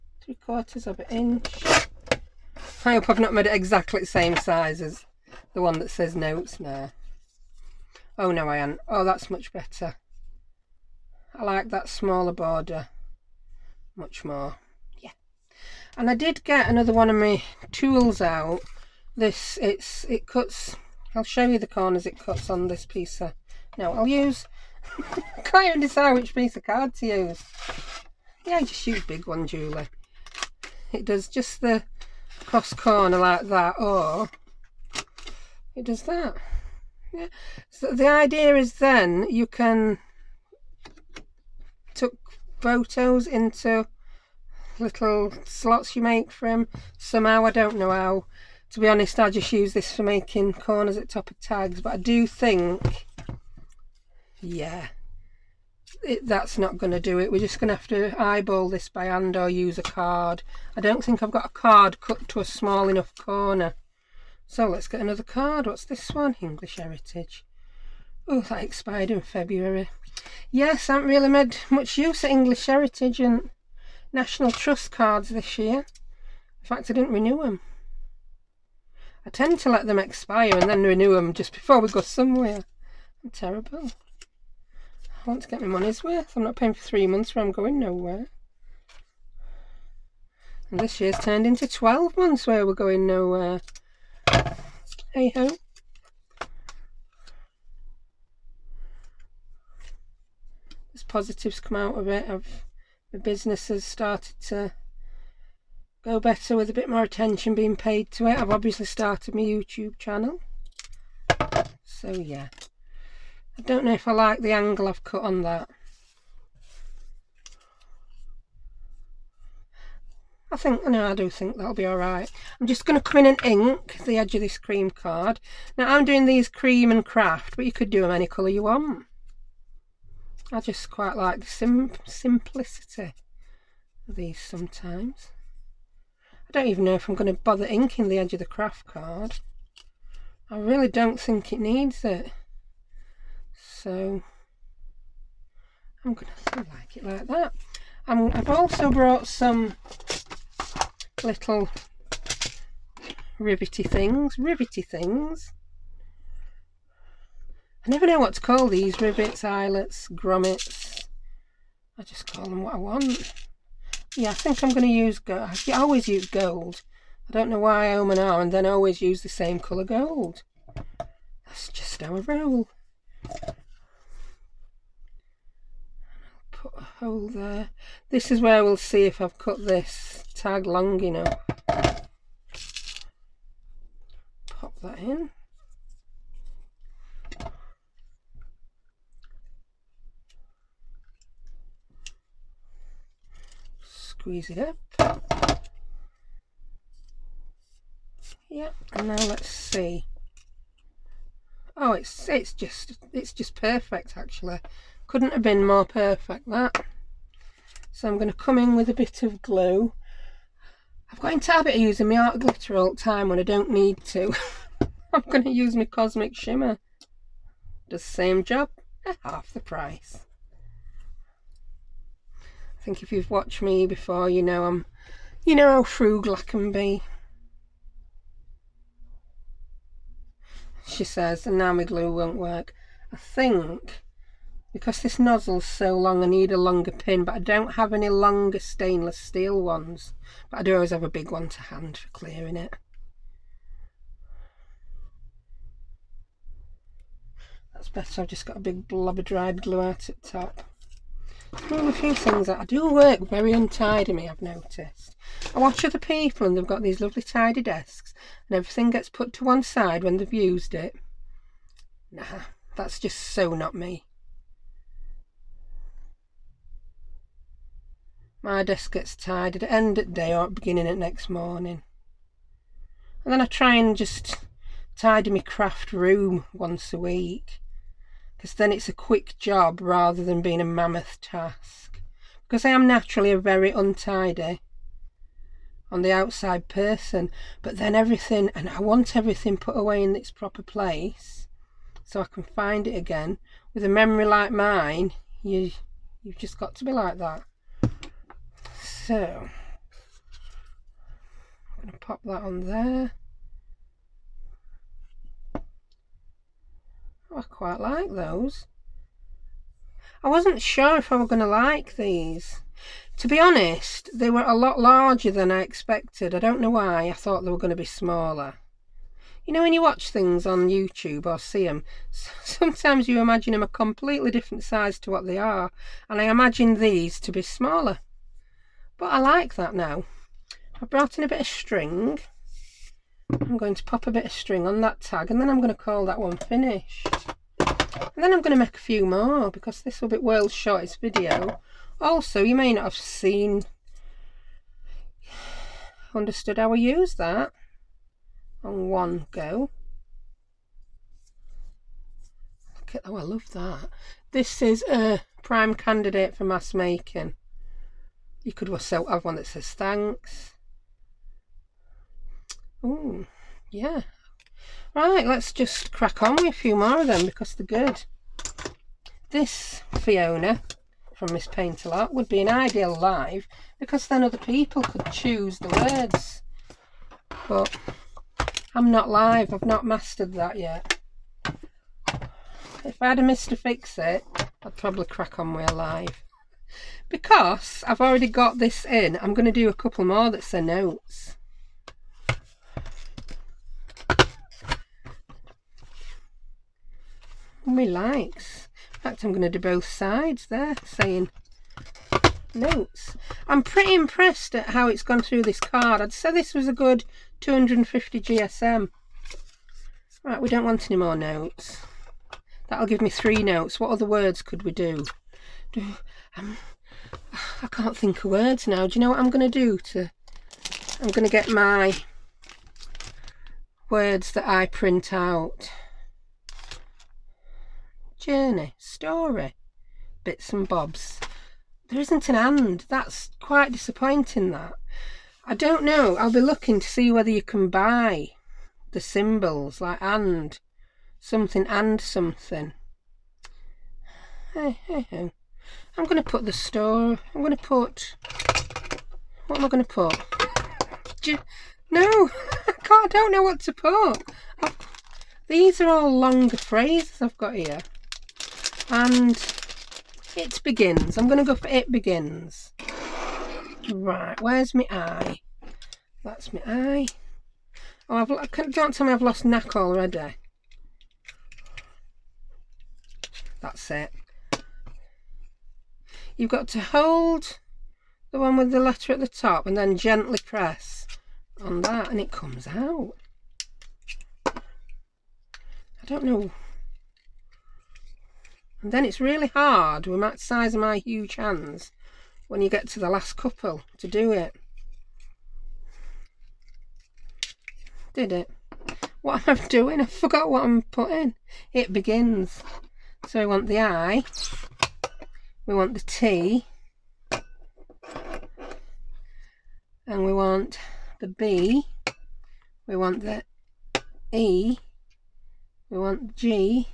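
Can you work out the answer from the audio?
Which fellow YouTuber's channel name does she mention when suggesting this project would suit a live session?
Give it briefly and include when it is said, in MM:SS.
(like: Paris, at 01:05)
Miss Paint a Lot, at 06:11.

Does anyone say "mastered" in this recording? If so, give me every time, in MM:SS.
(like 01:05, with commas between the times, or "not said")
06:19.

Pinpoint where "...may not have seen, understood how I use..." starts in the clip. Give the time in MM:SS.
05:42.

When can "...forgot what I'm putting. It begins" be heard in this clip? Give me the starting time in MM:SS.
08:20.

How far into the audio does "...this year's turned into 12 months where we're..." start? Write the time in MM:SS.
01:30.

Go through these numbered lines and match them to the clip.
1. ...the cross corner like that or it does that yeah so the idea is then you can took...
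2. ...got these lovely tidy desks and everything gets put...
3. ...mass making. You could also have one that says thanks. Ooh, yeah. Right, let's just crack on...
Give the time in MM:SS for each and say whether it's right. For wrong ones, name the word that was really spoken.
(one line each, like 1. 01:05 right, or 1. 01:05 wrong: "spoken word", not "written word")
1. 00:31 right
2. 04:16 right
3. 05:56 right.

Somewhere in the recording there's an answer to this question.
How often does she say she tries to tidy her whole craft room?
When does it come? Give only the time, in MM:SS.
04:36.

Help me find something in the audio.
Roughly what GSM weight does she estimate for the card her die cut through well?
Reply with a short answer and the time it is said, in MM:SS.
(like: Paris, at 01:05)
250 GSM, at 06:47.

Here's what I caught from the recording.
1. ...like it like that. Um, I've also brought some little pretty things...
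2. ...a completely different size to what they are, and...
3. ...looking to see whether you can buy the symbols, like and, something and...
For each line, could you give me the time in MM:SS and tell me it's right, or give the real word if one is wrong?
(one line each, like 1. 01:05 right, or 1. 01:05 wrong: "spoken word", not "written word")
1. 02:26 wrong: "rivety", not "pretty"
2. 05:23 right
3. 07:16 right.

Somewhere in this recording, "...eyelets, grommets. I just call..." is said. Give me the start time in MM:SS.
02:39.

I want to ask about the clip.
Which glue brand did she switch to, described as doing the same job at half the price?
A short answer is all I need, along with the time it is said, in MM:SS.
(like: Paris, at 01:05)
Cosmic Shimmer, at 03:35.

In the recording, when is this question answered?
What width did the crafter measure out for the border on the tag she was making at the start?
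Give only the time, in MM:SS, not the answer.
00:00.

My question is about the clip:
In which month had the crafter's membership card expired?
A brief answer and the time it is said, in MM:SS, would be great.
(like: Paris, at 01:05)
February, at 01:09.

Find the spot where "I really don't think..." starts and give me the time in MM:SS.
02:20.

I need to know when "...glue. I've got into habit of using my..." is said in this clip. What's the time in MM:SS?
03:29.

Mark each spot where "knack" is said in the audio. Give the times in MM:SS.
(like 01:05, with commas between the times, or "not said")
07:49.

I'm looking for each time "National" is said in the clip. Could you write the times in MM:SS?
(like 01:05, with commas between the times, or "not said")
01:14.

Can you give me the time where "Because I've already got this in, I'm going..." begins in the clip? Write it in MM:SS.
06:27.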